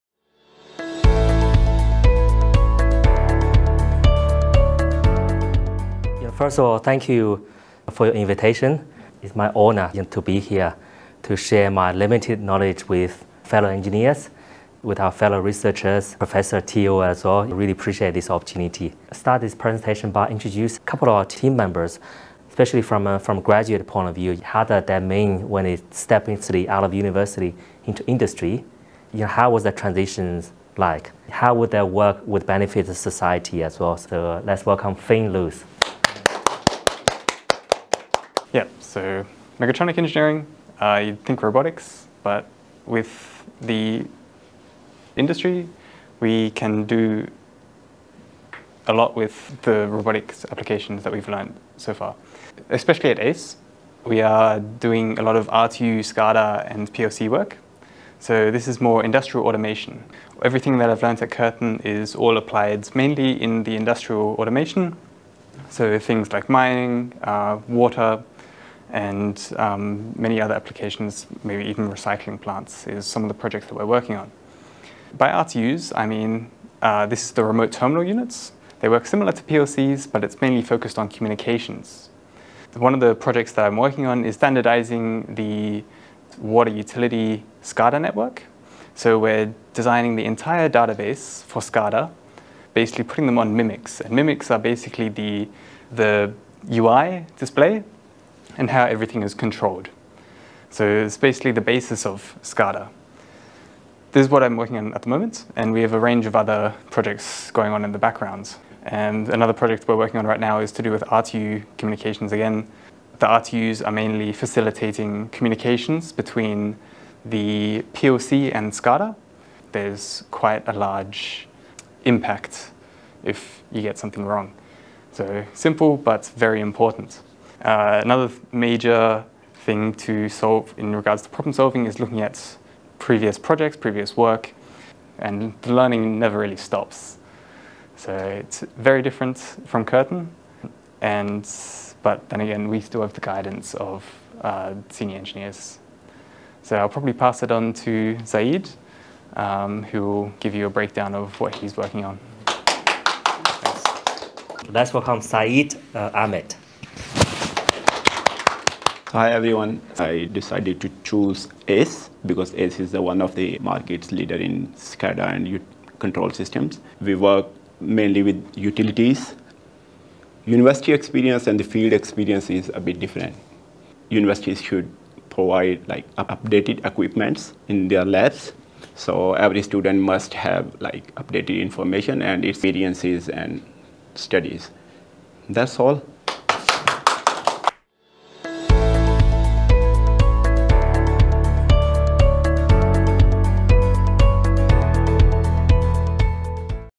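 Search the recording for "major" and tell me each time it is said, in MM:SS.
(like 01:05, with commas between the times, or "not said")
02:08.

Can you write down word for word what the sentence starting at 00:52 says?
Especially at ACE, we are doing a lot of RTU, SCADA and PLC work.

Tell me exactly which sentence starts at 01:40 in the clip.
So it's basically the basis of SCADA.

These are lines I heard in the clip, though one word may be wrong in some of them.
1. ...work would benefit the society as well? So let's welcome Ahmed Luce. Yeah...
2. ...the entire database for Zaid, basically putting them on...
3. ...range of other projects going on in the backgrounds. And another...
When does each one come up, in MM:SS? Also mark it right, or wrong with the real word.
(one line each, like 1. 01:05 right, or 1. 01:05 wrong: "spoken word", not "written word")
1. 00:31 wrong: "Finn", not "Ahmed"
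2. 01:30 wrong: "SCADA", not "Zaid"
3. 01:45 right.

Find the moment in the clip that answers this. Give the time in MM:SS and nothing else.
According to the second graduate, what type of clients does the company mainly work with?
02:48.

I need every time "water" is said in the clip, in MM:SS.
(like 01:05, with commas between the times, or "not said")
01:07, 01:26.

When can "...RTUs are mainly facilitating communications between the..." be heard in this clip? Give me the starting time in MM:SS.
01:53.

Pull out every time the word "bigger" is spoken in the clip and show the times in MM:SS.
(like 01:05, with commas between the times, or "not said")
not said.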